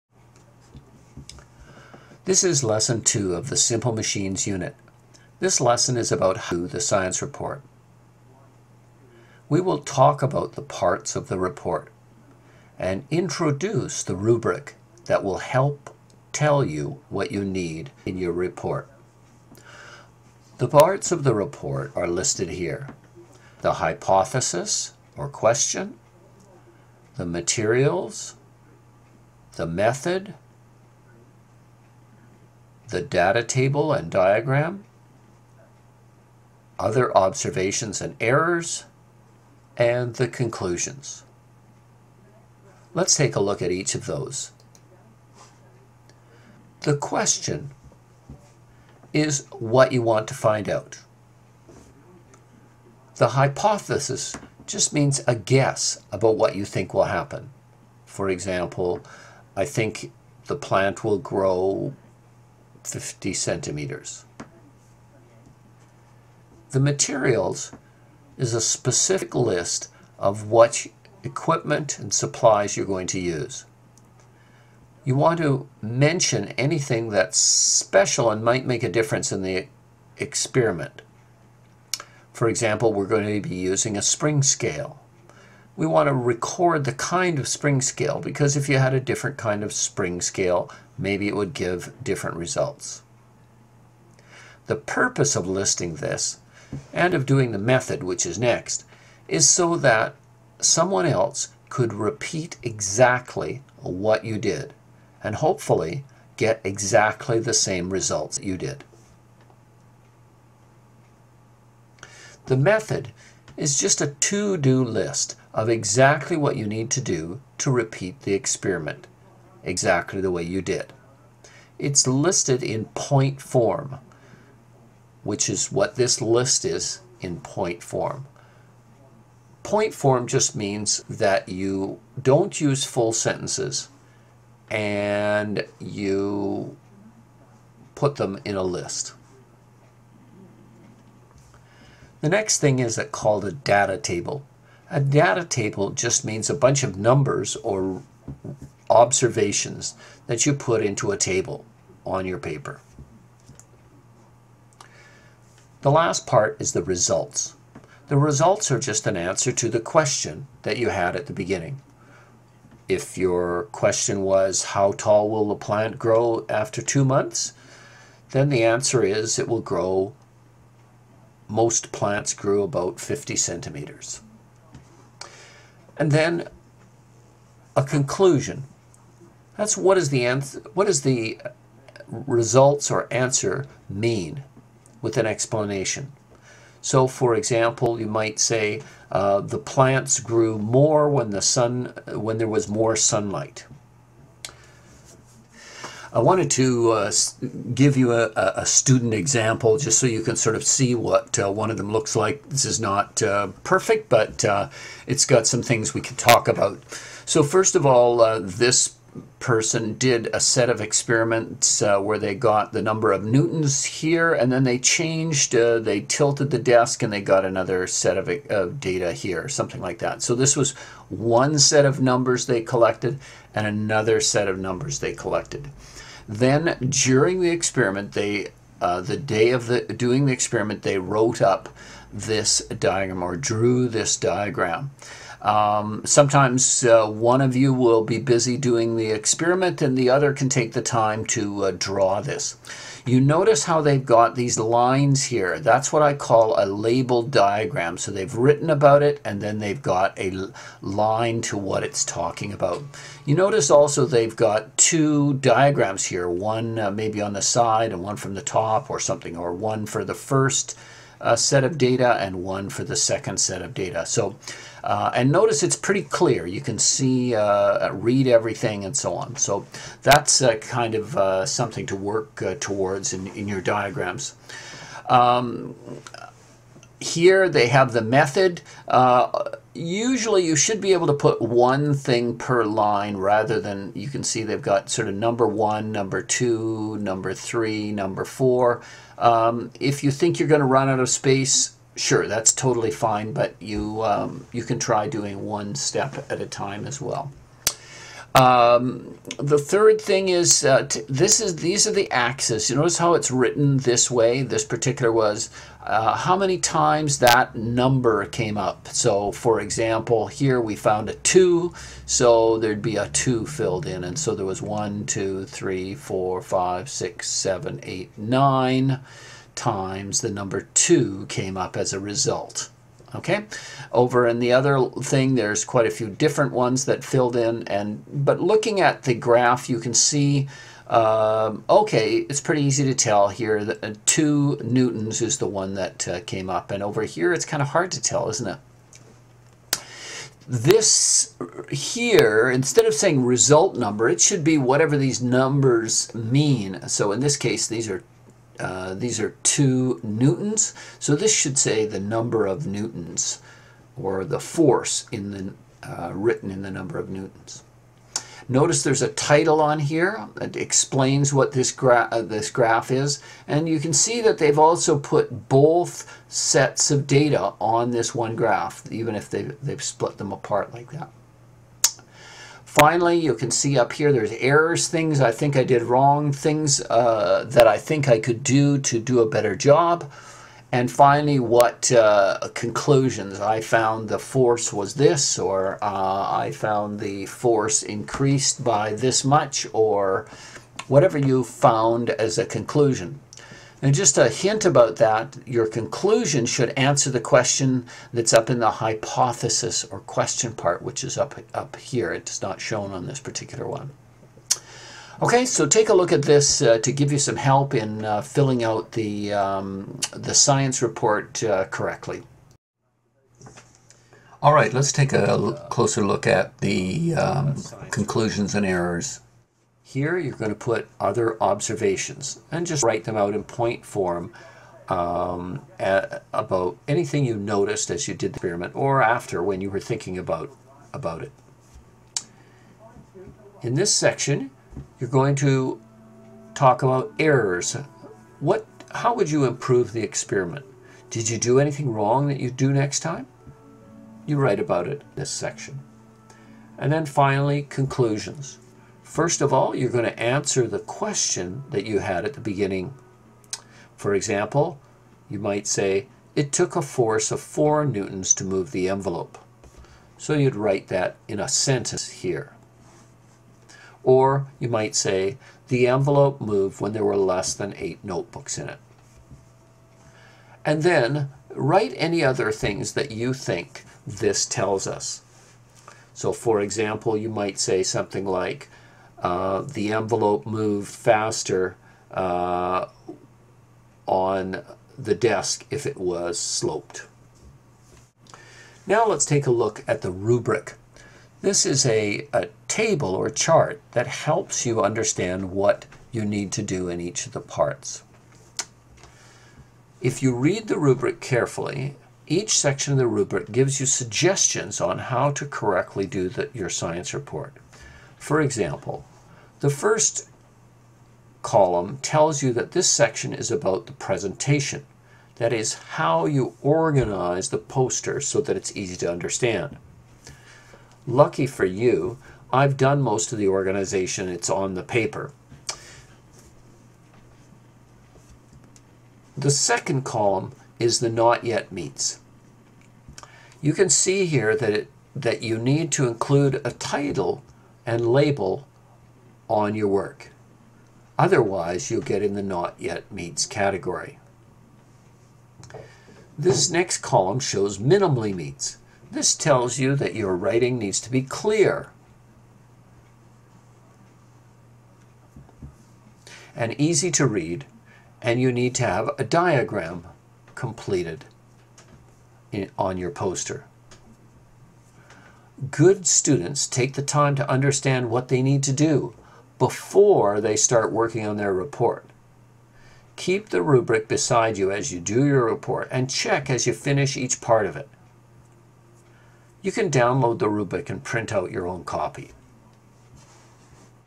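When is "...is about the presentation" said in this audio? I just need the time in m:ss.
8:33.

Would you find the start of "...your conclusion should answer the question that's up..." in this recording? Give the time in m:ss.
6:35.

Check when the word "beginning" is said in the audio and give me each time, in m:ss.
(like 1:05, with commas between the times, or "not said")
2:41, 7:32.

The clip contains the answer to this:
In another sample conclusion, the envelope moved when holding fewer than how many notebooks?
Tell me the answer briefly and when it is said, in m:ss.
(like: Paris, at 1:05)
8, at 7:47.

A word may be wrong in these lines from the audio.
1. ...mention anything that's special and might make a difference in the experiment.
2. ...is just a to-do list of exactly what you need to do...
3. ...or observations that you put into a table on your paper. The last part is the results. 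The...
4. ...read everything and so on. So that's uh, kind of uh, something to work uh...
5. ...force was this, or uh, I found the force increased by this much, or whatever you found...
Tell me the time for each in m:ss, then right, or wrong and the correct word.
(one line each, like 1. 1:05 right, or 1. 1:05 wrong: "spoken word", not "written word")
1. 1:15 right
2. 1:53 right
3. 2:27 right
4. 4:27 right
5. 6:24 right.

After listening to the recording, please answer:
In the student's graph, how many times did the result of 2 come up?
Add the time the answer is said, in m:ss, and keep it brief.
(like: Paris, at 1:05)
9, at 5:18.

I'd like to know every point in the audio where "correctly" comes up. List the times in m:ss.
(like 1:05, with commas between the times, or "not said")
6:51, 8:25.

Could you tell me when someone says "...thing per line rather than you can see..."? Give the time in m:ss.
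4:41.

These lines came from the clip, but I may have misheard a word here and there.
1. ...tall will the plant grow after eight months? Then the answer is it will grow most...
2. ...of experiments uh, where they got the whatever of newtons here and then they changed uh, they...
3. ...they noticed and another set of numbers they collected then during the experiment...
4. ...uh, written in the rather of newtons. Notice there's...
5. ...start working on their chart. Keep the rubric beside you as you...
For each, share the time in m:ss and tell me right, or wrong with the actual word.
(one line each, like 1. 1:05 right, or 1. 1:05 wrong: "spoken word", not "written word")
1. 2:44 wrong: "two", not "eight"
2. 3:30 wrong: "number", not "whatever"
3. 3:42 wrong: "collected", not "noticed"
4. 5:55 wrong: "number", not "rather"
5. 9:30 wrong: "report", not "chart".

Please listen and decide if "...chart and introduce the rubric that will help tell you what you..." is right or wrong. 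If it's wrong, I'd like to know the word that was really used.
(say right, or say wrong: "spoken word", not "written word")
wrong: "report", not "chart".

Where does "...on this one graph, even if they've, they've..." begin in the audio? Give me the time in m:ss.
6:07.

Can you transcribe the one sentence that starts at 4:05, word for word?
That's what I call a labeled diagram.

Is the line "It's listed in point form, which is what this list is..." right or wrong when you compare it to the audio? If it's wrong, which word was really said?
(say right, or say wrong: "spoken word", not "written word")
right.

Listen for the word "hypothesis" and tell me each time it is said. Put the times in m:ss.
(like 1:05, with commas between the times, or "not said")
0:23, 0:53, 6:38.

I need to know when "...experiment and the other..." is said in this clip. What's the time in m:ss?
3:59.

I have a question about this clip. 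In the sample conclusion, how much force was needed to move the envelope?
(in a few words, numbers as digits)
4 newtons.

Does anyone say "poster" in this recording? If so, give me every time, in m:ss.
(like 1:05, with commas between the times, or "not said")
8:37, 9:23.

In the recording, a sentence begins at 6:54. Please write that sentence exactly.
All right, let's take a closer look at the um, conclusions and errors.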